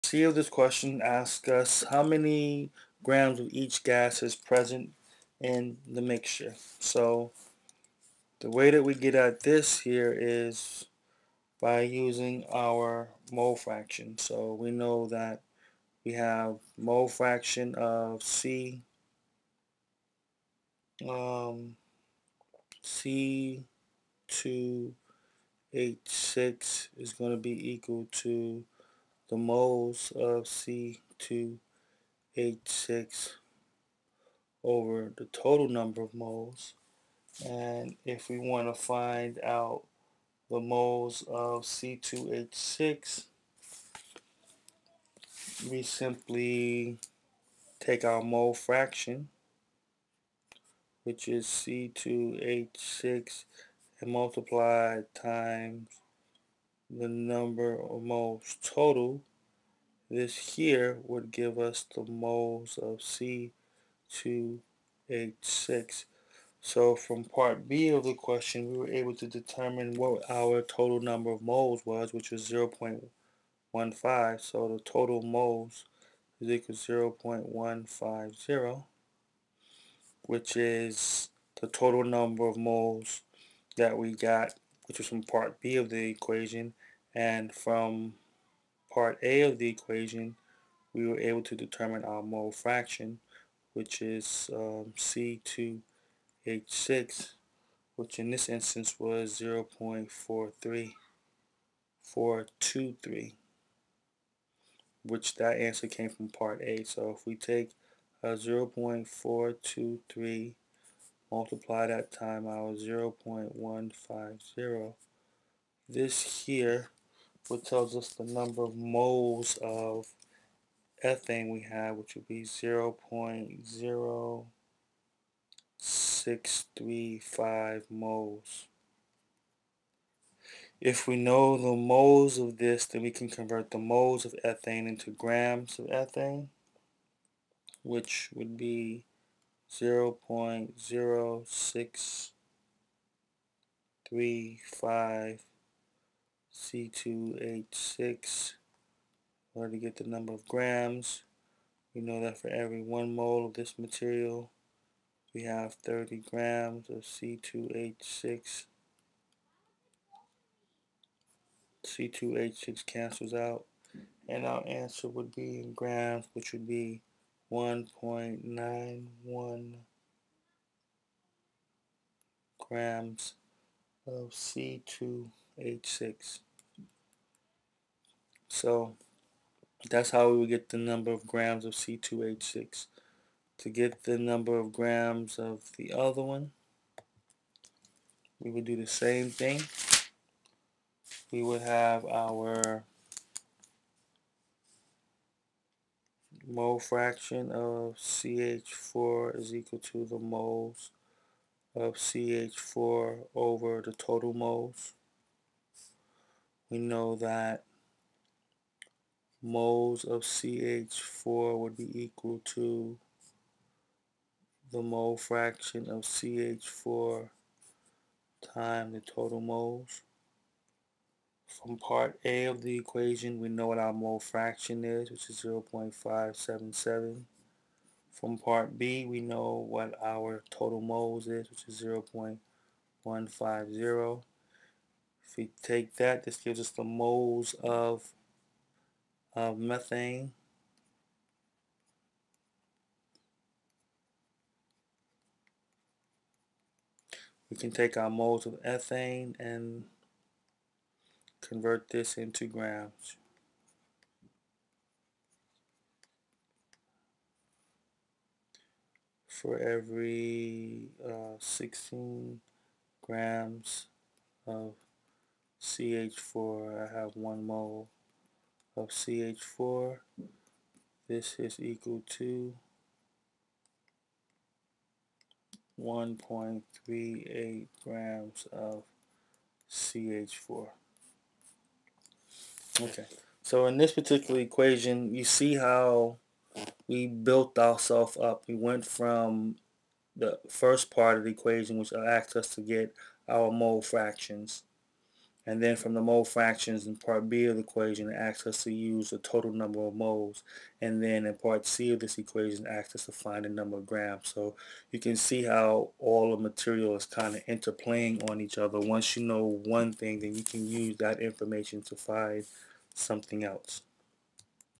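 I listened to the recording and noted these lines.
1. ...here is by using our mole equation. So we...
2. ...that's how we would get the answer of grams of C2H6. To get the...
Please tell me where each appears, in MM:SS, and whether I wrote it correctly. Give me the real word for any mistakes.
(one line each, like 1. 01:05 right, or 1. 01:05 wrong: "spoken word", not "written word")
1. 00:09 wrong: "fraction", not "equation"
2. 02:59 wrong: "number", not "answer".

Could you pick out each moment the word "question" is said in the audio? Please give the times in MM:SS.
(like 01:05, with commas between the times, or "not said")
00:00, 01:08.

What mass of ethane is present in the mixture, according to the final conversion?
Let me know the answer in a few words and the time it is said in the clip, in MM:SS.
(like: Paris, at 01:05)
1.91 grams, at 02:47.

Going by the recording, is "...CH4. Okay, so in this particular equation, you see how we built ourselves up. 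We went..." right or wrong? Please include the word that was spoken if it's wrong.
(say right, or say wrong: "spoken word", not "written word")
right.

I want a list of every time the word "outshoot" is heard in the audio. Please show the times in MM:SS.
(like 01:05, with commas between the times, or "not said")
not said.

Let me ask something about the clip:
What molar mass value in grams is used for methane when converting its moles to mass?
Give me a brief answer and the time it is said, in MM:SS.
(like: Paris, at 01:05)
16 grams, at 04:21.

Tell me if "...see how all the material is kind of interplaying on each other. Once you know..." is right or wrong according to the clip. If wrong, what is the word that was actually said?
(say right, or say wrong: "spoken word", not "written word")
right.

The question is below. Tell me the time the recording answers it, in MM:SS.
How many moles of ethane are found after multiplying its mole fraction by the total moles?
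02:03.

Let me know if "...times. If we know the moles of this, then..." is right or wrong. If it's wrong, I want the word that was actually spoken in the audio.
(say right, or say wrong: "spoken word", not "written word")
wrong: "moles", not "times".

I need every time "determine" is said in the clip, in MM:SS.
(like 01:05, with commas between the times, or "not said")
01:09, 01:31.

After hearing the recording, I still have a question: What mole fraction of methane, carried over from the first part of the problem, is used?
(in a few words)
0.577.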